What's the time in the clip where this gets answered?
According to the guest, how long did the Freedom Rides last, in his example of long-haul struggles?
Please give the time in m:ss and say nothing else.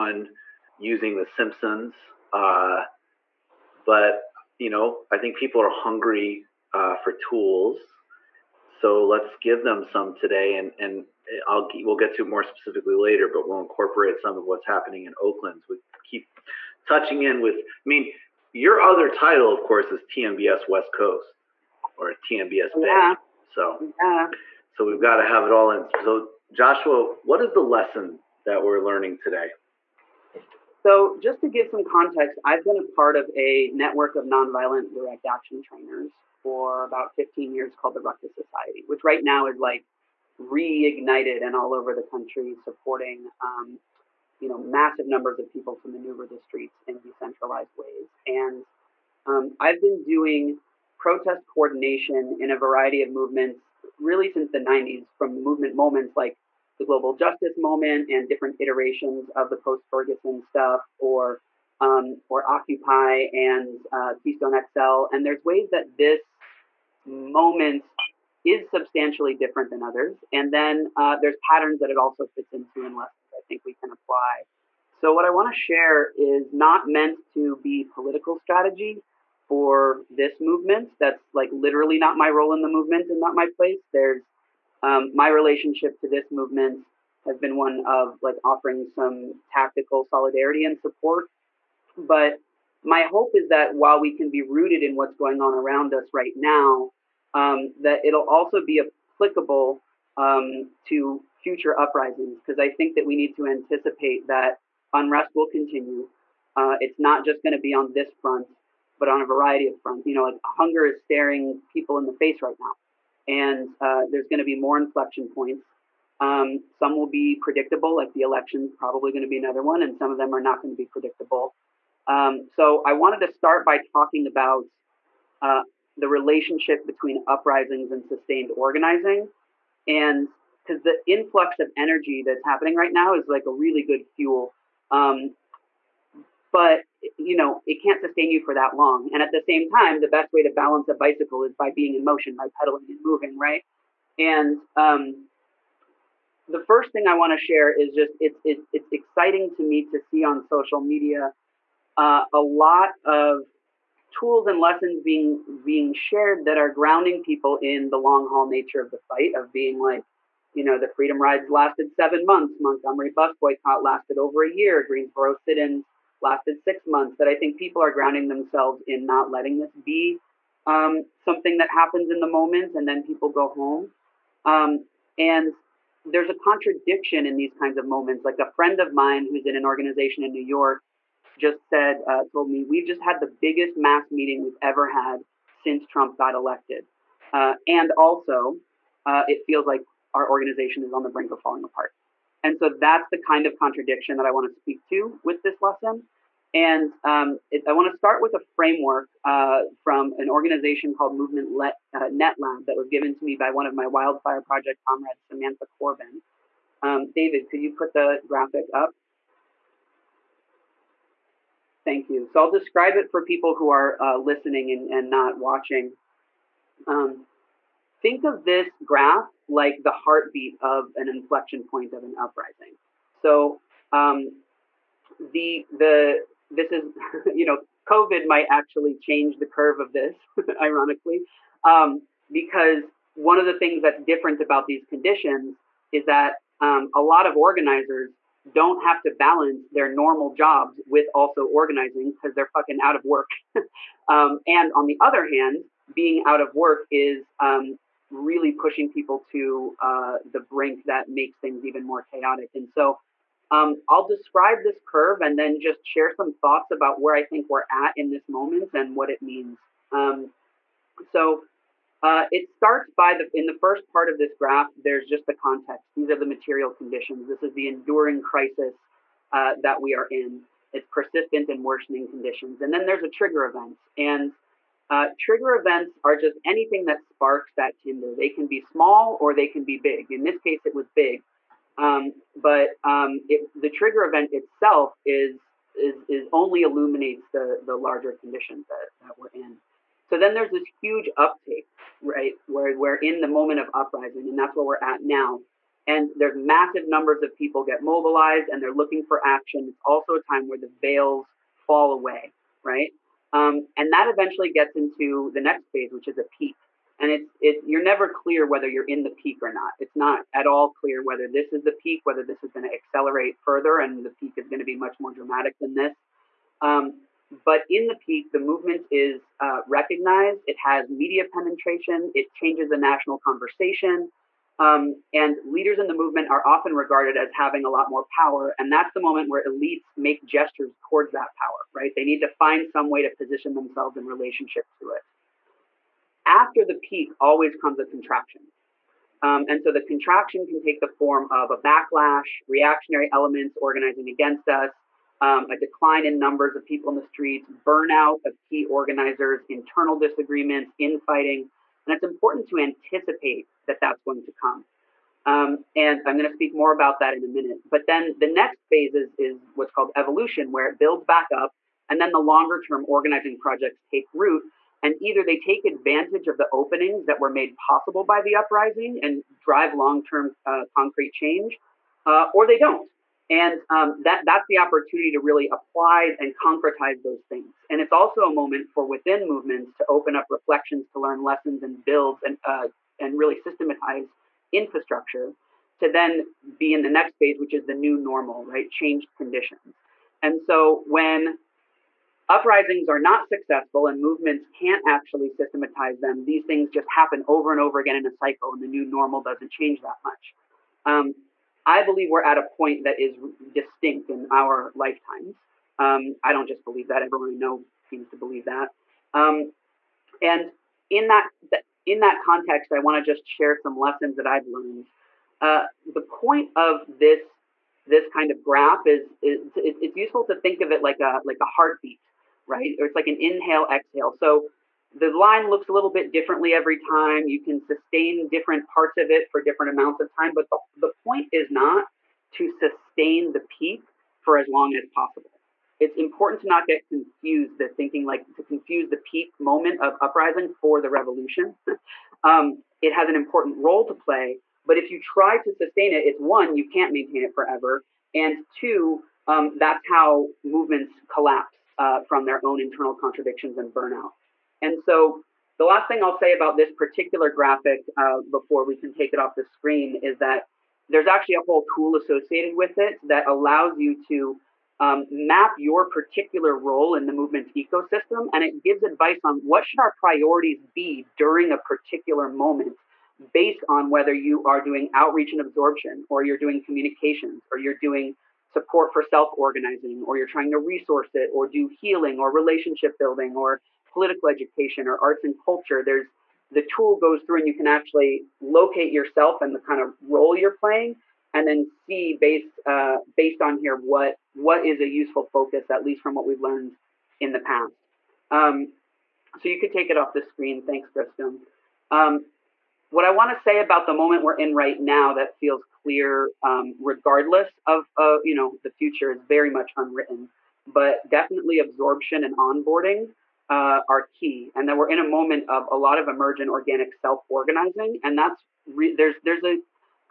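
2:41.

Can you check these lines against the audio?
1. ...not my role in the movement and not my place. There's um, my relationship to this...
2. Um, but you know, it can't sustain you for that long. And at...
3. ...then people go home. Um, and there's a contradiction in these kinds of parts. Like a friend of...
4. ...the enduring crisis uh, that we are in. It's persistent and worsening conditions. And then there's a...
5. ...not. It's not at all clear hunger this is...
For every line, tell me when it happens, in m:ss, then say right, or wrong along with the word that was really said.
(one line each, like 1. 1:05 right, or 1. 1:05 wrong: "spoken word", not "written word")
1. 1:21 right
2. 2:14 right
3. 2:52 wrong: "moments", not "parts"
4. 4:27 right
5. 5:09 wrong: "whether", not "hunger".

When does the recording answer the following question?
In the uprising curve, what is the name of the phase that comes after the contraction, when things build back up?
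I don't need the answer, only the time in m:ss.
5:59.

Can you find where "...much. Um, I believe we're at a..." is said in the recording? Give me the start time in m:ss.
6:40.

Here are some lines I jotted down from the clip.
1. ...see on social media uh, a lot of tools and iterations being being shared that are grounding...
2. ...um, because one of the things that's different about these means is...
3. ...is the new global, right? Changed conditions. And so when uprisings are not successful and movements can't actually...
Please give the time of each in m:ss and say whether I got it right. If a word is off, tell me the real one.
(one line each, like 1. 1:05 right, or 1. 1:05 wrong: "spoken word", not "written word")
1. 2:29 wrong: "lessons", not "iterations"
2. 3:51 wrong: "conditions", not "means"
3. 6:27 wrong: "normal", not "global".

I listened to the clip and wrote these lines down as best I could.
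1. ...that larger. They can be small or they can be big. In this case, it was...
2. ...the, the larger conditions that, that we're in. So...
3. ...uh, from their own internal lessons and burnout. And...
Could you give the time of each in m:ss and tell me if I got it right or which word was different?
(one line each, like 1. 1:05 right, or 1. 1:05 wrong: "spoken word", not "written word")
1. 4:37 wrong: "tinder", not "larger"
2. 4:47 right
3. 7:31 wrong: "contradictions", not "lessons".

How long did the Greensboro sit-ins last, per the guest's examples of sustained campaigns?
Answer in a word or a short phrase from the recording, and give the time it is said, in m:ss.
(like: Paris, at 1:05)
6 months, at 2:46.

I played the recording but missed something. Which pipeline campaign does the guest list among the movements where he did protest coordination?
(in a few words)
Keystone XL.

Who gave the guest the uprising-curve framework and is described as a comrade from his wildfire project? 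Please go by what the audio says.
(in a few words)
Samantha Corbin.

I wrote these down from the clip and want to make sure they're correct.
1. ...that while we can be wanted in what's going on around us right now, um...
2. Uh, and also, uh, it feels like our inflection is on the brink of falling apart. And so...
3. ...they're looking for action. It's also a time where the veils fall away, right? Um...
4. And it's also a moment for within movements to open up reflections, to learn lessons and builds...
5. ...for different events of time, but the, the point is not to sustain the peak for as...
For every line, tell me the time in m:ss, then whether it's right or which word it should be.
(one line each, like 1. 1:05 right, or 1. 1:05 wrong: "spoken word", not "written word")
1. 1:33 wrong: "rooted", not "wanted"
2. 3:07 wrong: "organization", not "inflection"
3. 4:58 right
4. 6:17 right
5. 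7:09 wrong: "amounts", not "events".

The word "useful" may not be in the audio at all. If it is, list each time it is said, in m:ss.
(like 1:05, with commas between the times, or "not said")
6:59, 8:14.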